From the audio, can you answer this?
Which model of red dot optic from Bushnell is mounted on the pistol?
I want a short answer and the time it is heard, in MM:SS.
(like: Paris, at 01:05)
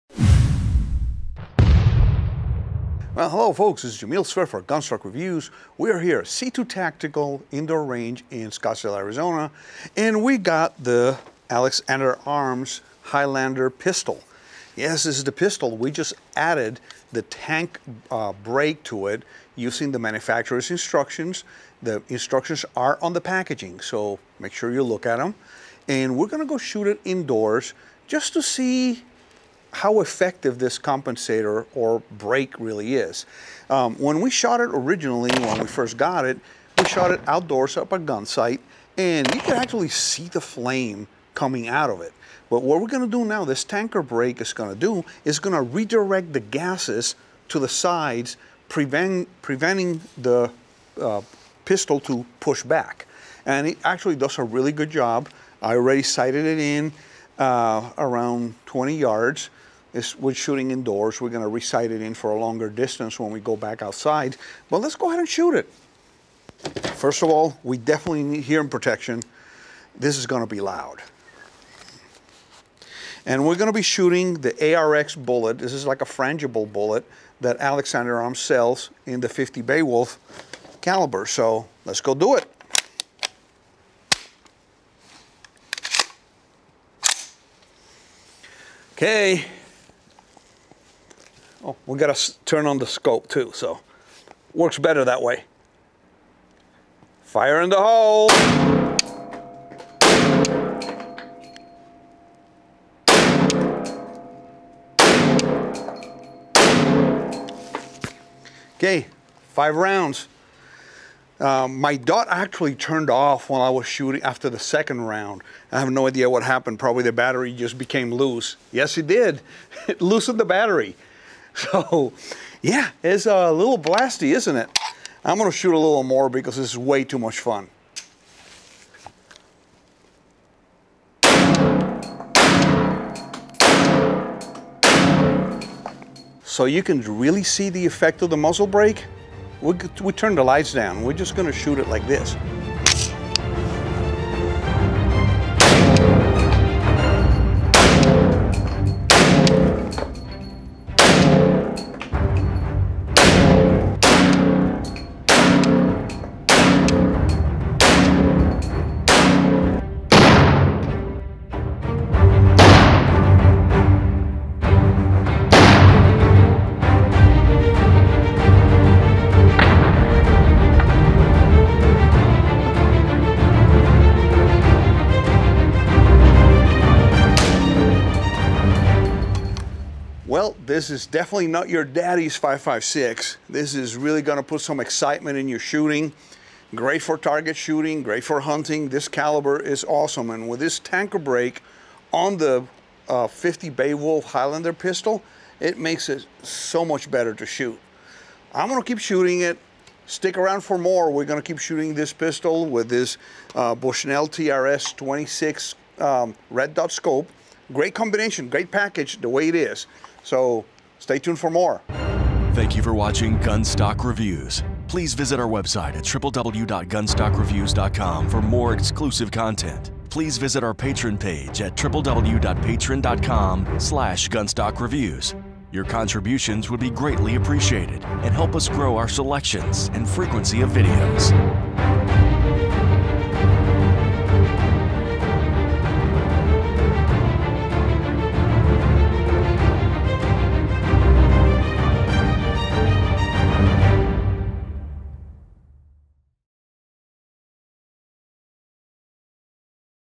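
TRS 26, at 03:24.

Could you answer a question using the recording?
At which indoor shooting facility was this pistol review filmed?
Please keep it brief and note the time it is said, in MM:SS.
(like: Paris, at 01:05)
C2 Tactical Indoor Range, at 00:06.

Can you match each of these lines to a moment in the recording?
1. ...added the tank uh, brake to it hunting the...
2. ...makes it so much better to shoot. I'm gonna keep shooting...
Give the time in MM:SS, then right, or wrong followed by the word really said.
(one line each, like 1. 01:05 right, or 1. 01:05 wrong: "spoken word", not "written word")
1. 00:16 wrong: "using", not "hunting"
2. 03:15 right.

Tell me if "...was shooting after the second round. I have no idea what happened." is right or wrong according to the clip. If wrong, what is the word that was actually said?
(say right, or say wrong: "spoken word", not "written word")
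right.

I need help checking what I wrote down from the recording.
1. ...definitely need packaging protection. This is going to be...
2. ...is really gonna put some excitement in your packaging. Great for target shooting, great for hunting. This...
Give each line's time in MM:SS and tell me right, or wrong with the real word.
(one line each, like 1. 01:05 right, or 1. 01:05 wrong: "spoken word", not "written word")
1. 01:07 wrong: "hearing", not "packaging"
2. 03:03 wrong: "shooting", not "packaging".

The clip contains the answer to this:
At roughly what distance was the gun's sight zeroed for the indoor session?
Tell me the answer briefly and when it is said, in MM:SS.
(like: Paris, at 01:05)
20 yards, at 00:58.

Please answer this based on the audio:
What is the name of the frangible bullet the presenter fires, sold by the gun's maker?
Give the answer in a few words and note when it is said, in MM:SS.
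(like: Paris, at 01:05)
ARX, at 01:14.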